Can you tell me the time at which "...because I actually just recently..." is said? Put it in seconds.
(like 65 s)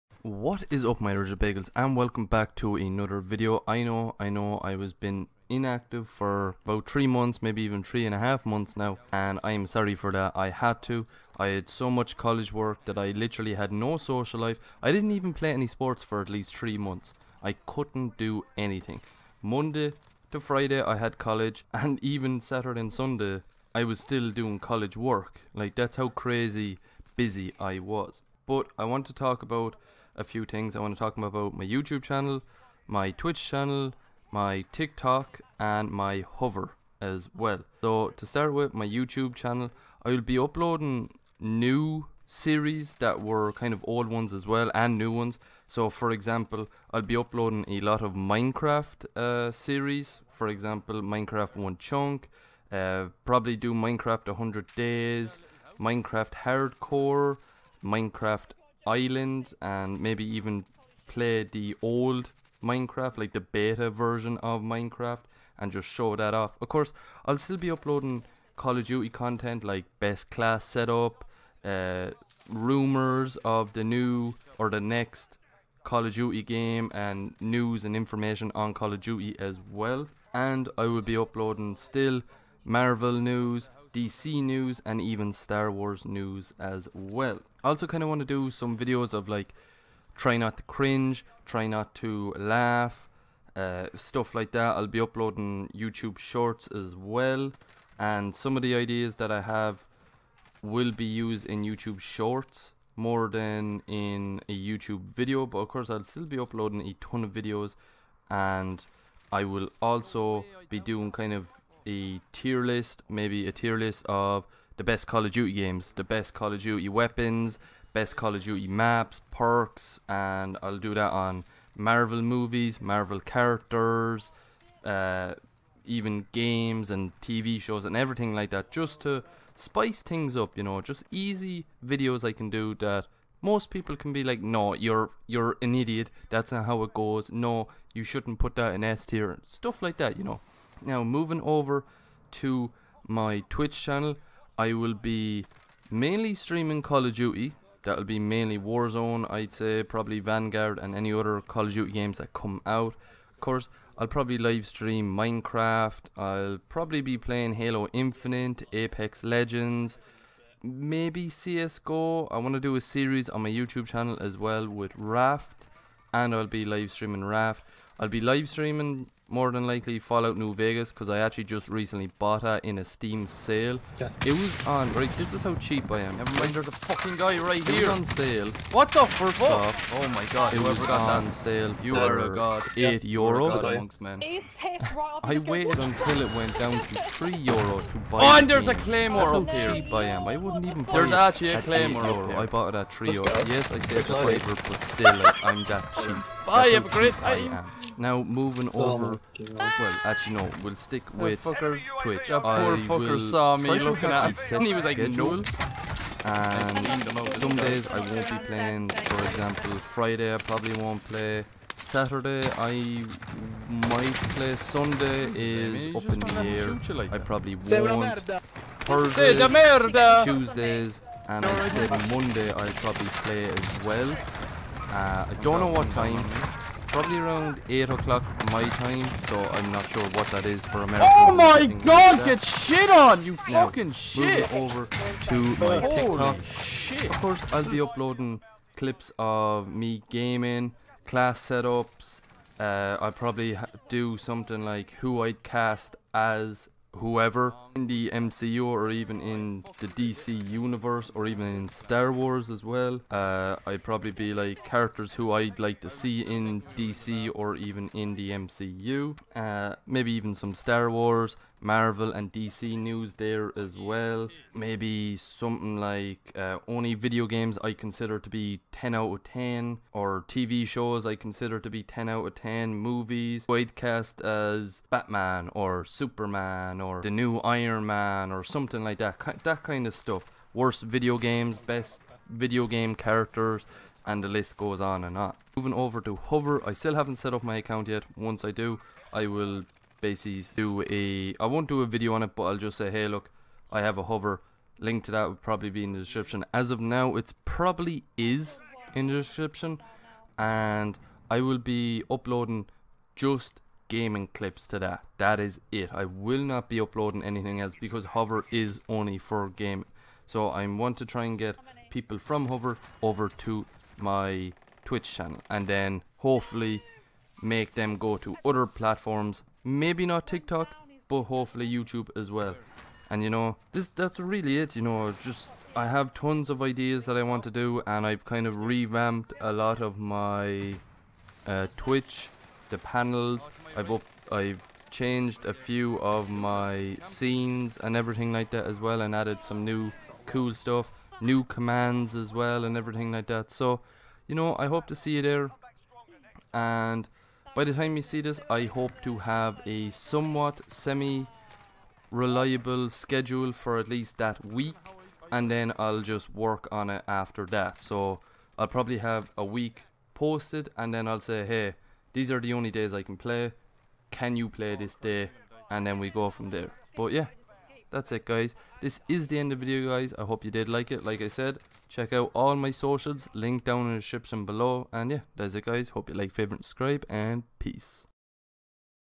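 170 s.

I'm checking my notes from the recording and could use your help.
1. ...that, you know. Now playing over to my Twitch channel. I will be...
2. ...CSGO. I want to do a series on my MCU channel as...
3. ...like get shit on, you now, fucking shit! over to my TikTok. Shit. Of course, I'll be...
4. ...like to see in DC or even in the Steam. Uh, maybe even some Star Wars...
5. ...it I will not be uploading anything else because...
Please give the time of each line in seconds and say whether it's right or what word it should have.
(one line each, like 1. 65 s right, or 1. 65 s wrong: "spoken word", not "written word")
1. 139 s wrong: "moving", not "playing"
2. 161 s wrong: "YouTube", not "MCU"
3. 232 s right
4. 255 s wrong: "MCU", not "Steam"
5. 305 s right.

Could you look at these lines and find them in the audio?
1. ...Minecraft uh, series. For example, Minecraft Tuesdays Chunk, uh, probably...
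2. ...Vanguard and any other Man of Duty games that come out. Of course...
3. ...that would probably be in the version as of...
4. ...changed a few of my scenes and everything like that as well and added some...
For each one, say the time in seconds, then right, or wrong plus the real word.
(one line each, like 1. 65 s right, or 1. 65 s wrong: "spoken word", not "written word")
1. 48 s wrong: "One", not "Tuesdays"
2. 150 s wrong: "Call", not "Man"
3. 295 s wrong: "description", not "version"
4. 334 s right.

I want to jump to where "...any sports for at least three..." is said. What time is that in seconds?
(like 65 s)
15 s.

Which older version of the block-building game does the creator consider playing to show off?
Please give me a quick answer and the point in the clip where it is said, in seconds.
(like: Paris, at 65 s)
beta version, at 63 s.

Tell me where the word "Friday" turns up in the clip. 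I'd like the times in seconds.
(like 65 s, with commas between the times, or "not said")
20 s, 209 s.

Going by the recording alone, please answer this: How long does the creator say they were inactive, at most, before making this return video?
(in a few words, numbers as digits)
3 and a half months.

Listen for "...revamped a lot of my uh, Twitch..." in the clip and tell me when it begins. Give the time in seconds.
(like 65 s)
328 s.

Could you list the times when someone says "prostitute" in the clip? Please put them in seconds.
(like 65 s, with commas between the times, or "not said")
not said.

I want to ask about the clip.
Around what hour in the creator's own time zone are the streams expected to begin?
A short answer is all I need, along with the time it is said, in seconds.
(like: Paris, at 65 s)
8 o'clock, at 227 s.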